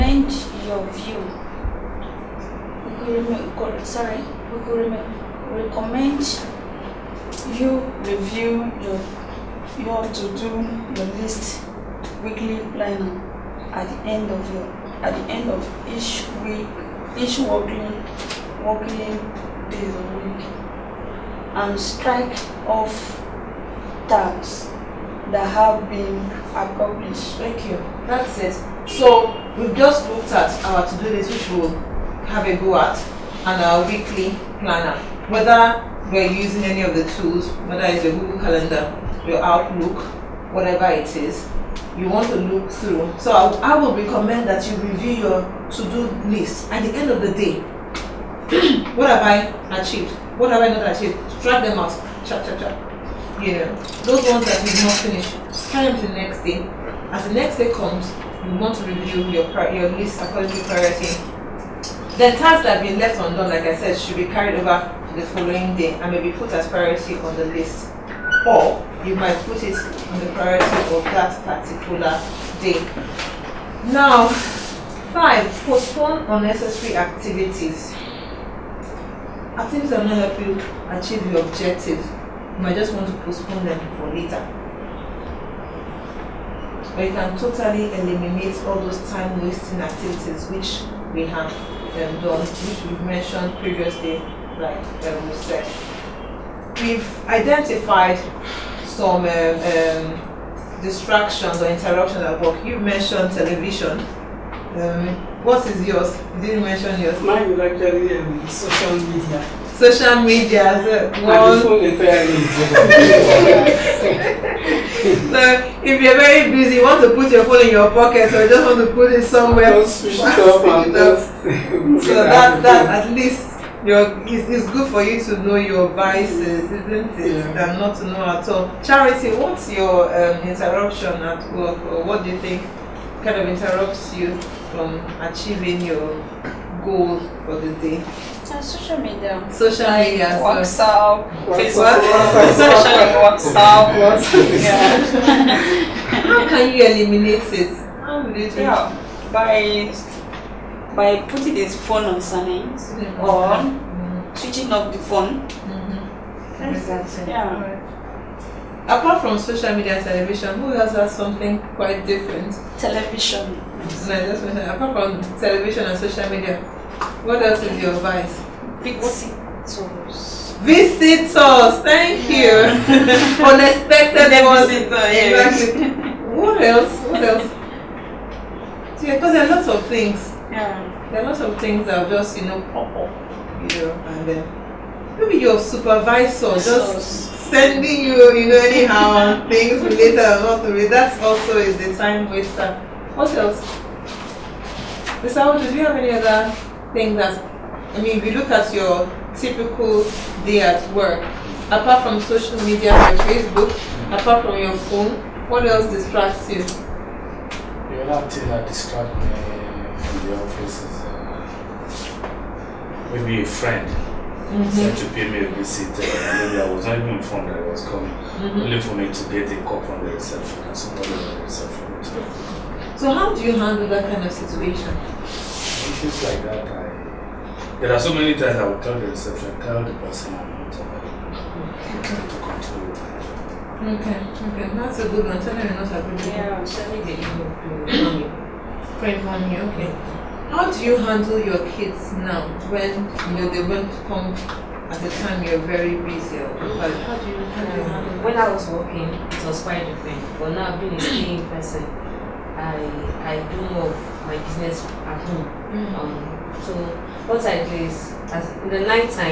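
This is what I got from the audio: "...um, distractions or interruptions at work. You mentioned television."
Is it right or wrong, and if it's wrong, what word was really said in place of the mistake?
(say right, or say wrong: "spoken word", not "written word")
right.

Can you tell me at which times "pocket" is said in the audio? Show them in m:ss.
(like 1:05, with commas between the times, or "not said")
1:57.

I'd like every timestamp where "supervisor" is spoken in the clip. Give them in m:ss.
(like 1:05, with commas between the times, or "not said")
3:05.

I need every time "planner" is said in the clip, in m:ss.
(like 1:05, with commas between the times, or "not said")
0:12, 0:34.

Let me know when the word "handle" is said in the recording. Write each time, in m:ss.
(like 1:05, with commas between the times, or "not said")
3:43, 4:00, 4:07.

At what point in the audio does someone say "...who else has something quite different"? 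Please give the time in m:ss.
2:40.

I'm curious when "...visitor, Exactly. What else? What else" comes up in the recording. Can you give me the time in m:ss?
2:54.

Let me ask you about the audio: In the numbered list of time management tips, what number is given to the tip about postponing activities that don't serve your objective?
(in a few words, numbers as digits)
5.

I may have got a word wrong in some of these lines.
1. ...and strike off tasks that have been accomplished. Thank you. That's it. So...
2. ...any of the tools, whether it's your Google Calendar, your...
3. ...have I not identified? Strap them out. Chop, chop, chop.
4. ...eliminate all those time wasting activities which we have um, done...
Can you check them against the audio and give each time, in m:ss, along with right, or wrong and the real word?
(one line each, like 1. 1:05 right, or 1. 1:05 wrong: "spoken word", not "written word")
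1. 0:21 right
2. 0:36 right
3. 0:50 wrong: "achieved", not "identified"
4. 1:27 right.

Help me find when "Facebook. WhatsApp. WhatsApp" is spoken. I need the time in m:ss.
2:21.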